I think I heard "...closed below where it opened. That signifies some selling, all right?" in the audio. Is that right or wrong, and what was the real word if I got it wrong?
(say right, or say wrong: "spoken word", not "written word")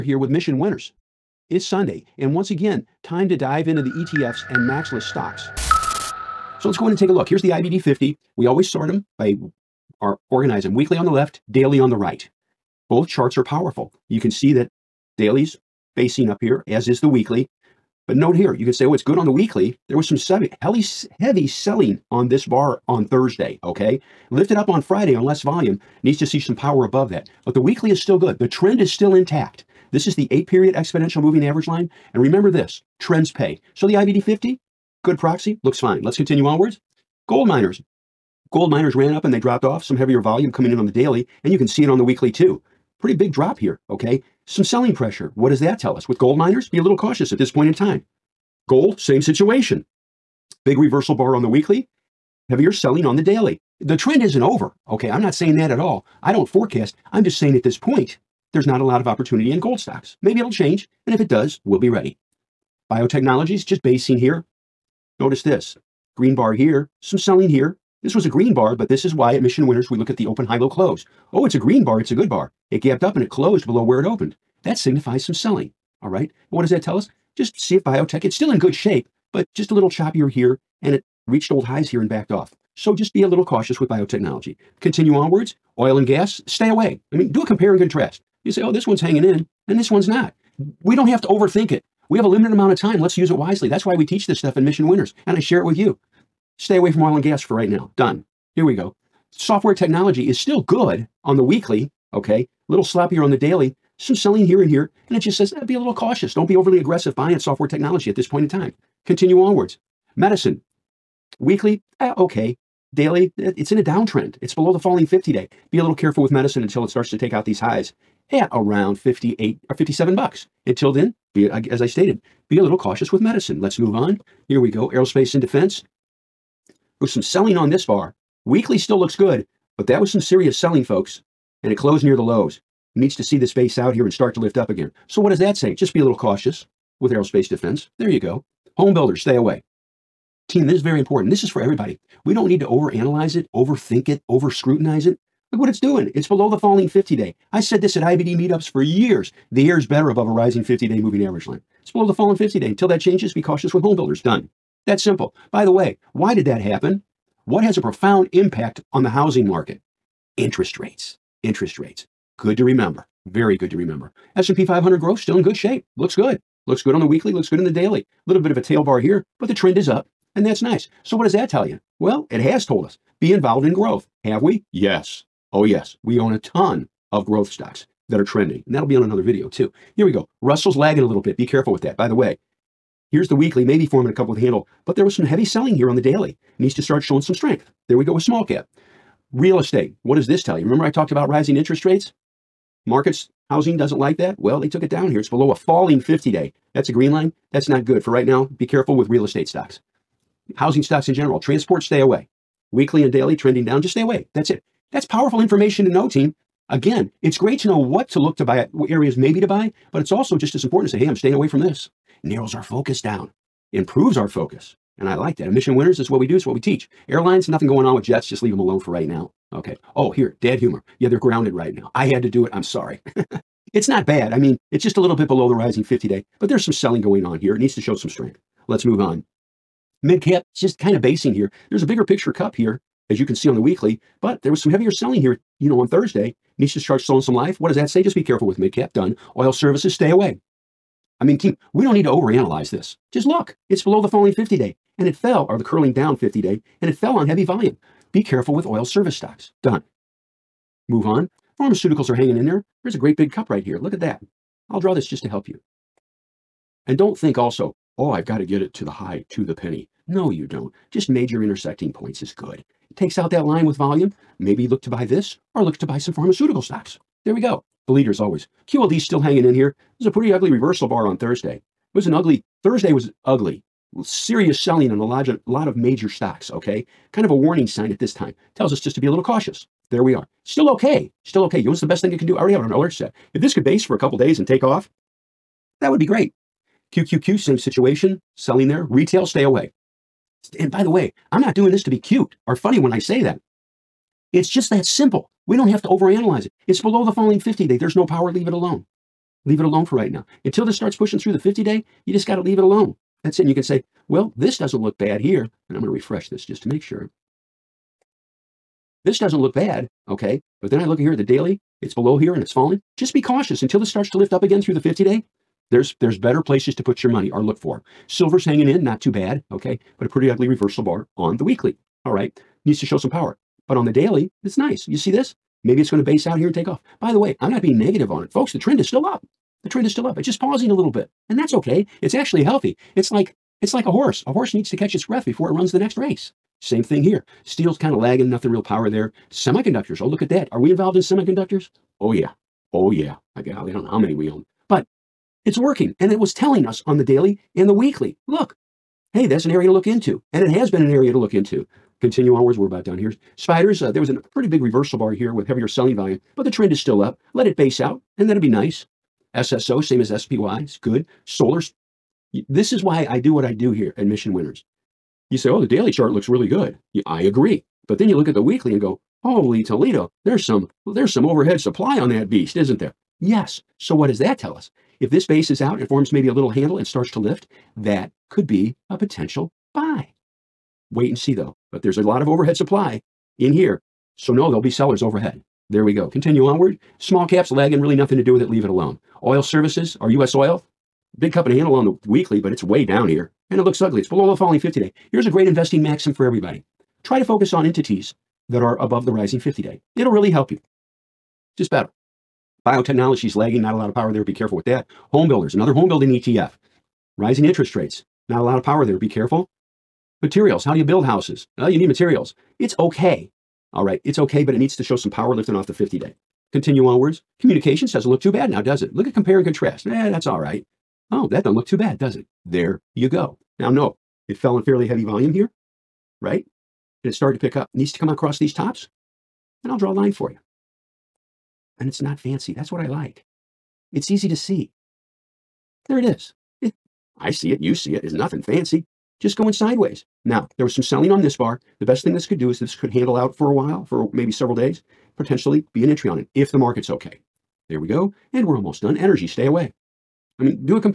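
right.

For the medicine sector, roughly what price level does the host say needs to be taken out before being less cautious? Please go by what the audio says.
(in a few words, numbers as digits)
57 dollars.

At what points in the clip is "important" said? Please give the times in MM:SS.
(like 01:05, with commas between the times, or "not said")
02:20, 03:30.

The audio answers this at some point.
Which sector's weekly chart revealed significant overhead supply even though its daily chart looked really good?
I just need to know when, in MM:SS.
06:01.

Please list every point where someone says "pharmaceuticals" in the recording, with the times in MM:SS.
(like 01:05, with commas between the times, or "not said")
04:11, 04:26.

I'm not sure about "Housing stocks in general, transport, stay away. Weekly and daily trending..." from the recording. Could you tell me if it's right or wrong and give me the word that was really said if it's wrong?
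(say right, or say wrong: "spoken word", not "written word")
right.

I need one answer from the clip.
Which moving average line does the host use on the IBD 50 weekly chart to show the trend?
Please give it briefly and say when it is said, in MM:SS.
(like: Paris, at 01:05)
8 period exponential, at 00:30.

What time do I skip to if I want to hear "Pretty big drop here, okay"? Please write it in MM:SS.
00:42.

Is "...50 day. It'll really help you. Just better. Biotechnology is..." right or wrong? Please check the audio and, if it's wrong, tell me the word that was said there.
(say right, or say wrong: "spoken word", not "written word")
right.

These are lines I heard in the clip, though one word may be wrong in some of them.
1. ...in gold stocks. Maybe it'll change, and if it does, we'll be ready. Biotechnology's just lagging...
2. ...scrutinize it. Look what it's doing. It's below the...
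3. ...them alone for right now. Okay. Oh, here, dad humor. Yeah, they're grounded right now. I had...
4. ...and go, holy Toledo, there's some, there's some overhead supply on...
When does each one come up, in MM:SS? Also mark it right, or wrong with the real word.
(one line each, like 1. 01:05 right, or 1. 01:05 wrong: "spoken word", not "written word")
1. 00:59 wrong: "basing", not "lagging"
2. 02:24 right
3. 03:38 right
4. 06:08 right.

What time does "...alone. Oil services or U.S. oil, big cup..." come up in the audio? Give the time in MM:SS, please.
06:28.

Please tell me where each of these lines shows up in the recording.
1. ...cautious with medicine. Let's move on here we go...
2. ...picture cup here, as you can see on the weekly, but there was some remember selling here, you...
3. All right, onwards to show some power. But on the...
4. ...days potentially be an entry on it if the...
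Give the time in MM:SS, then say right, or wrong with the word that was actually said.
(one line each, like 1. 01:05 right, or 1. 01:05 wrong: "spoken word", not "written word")
1. 02:02 right
2. 03:52 wrong: "heavier", not "remember"
3. 05:22 wrong: "needs", not "onwards"
4. 07:24 right.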